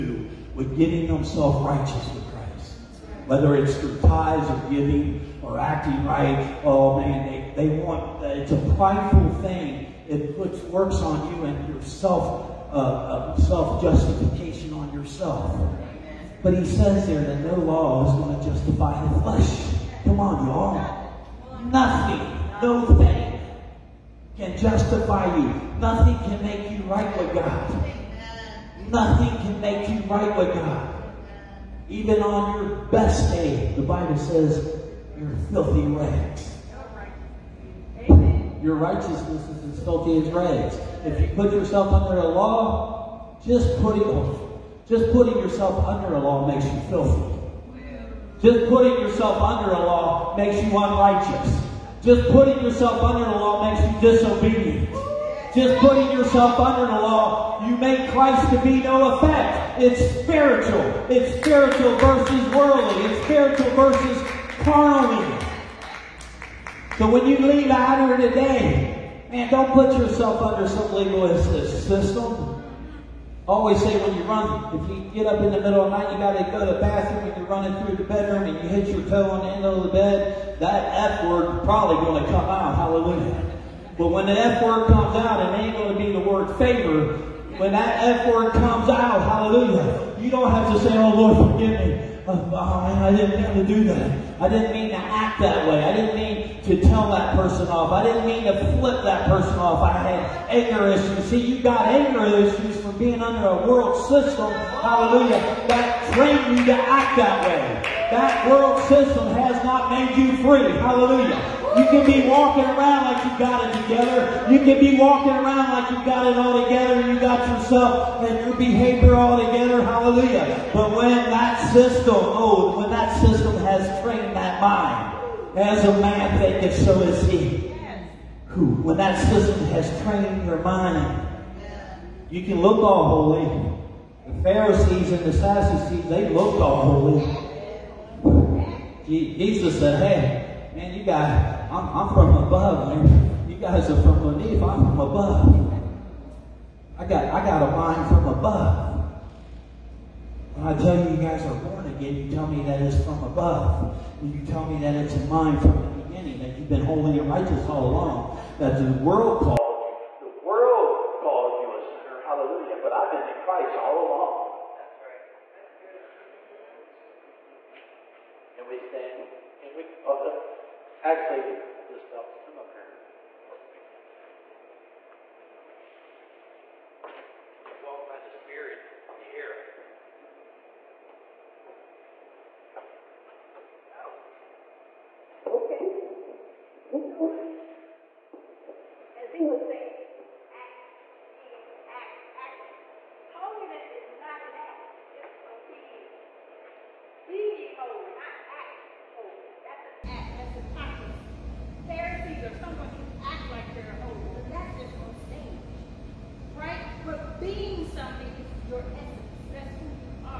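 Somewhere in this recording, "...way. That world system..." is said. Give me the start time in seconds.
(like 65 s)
107 s.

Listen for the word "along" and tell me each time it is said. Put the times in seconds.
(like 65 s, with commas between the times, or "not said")
157 s, 164 s.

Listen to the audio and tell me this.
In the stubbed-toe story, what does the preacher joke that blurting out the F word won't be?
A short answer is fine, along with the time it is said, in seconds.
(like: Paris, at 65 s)
favor, at 86 s.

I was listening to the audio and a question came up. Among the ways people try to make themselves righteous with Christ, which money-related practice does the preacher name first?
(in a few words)
tithes.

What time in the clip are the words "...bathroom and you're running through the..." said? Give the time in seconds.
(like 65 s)
76 s.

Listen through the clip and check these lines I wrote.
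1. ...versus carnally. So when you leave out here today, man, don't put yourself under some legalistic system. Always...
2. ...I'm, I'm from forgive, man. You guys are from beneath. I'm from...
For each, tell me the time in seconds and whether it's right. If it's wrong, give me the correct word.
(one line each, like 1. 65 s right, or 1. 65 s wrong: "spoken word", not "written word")
1. 63 s right
2. 141 s wrong: "above", not "forgive".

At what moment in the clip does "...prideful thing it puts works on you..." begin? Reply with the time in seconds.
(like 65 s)
8 s.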